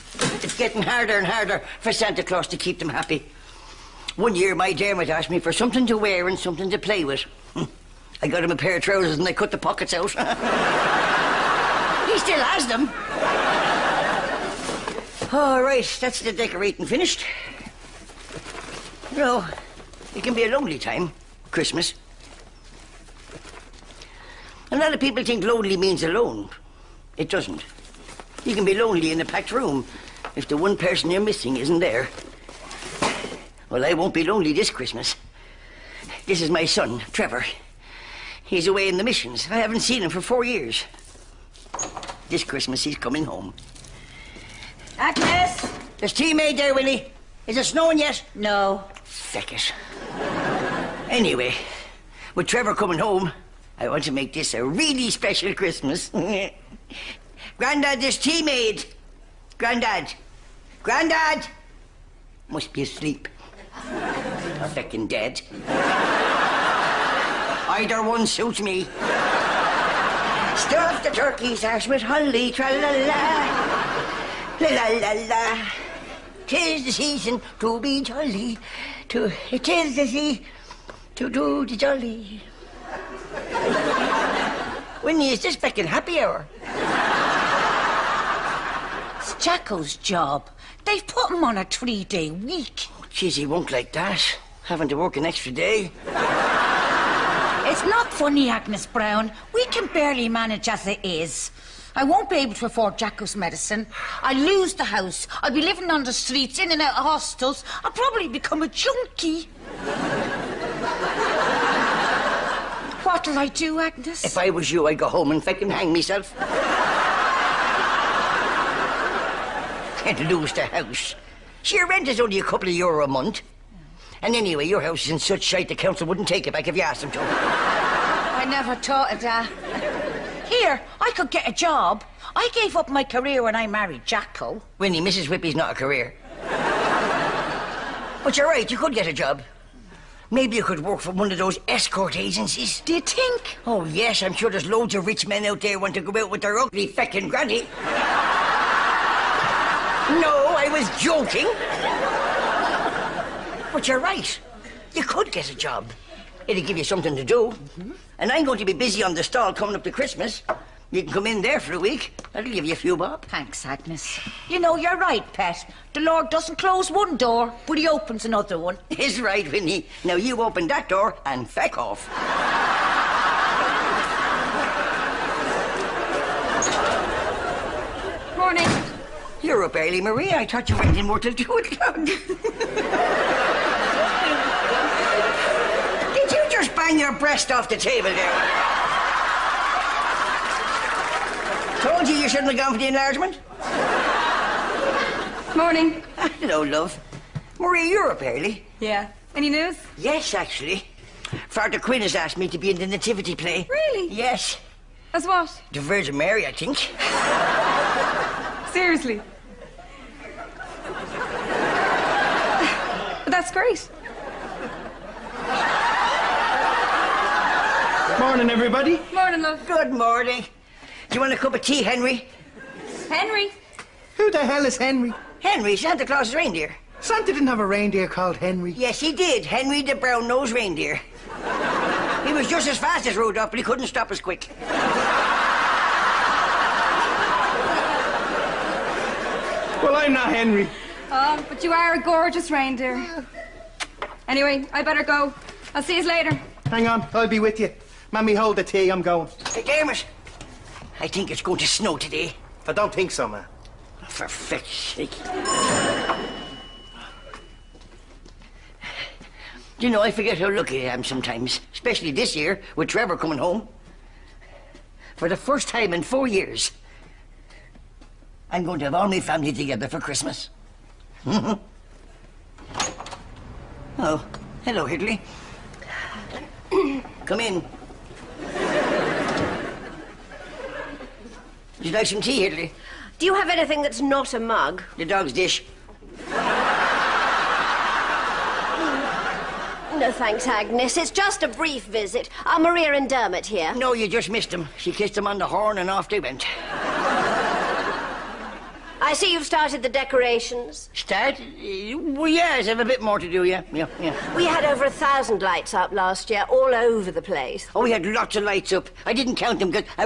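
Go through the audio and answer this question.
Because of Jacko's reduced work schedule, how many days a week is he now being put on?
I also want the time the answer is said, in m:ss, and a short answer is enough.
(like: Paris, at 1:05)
3, at 1:31.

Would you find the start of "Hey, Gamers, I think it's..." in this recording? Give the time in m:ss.
4:09.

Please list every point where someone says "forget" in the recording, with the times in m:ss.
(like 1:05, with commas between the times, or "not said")
4:20.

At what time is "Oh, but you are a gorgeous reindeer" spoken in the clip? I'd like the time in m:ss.
4:01.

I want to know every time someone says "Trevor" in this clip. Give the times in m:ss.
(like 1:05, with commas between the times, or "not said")
0:37, 0:52, 4:22.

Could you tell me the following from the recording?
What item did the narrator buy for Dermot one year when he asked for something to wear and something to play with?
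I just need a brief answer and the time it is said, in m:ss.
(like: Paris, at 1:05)
a pair of trousers, at 0:08.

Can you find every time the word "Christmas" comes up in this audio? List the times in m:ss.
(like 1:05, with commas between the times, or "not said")
0:21, 0:34, 0:42, 0:55, 2:39, 4:29.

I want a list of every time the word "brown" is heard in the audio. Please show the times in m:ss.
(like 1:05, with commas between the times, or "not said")
1:38, 3:49.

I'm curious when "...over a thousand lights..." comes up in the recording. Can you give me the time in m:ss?
5:04.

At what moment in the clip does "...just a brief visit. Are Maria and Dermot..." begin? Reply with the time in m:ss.
4:51.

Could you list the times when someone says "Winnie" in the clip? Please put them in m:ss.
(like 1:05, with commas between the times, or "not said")
1:25, 2:14, 2:49.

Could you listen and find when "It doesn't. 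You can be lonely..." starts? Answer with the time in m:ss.
0:27.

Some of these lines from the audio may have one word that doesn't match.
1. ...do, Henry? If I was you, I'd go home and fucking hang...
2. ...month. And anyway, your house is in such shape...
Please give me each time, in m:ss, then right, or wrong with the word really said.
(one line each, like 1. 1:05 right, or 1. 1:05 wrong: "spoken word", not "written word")
1. 1:53 wrong: "Agnes", not "Henry"
2. 2:03 right.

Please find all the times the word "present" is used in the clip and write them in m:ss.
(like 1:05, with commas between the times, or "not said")
not said.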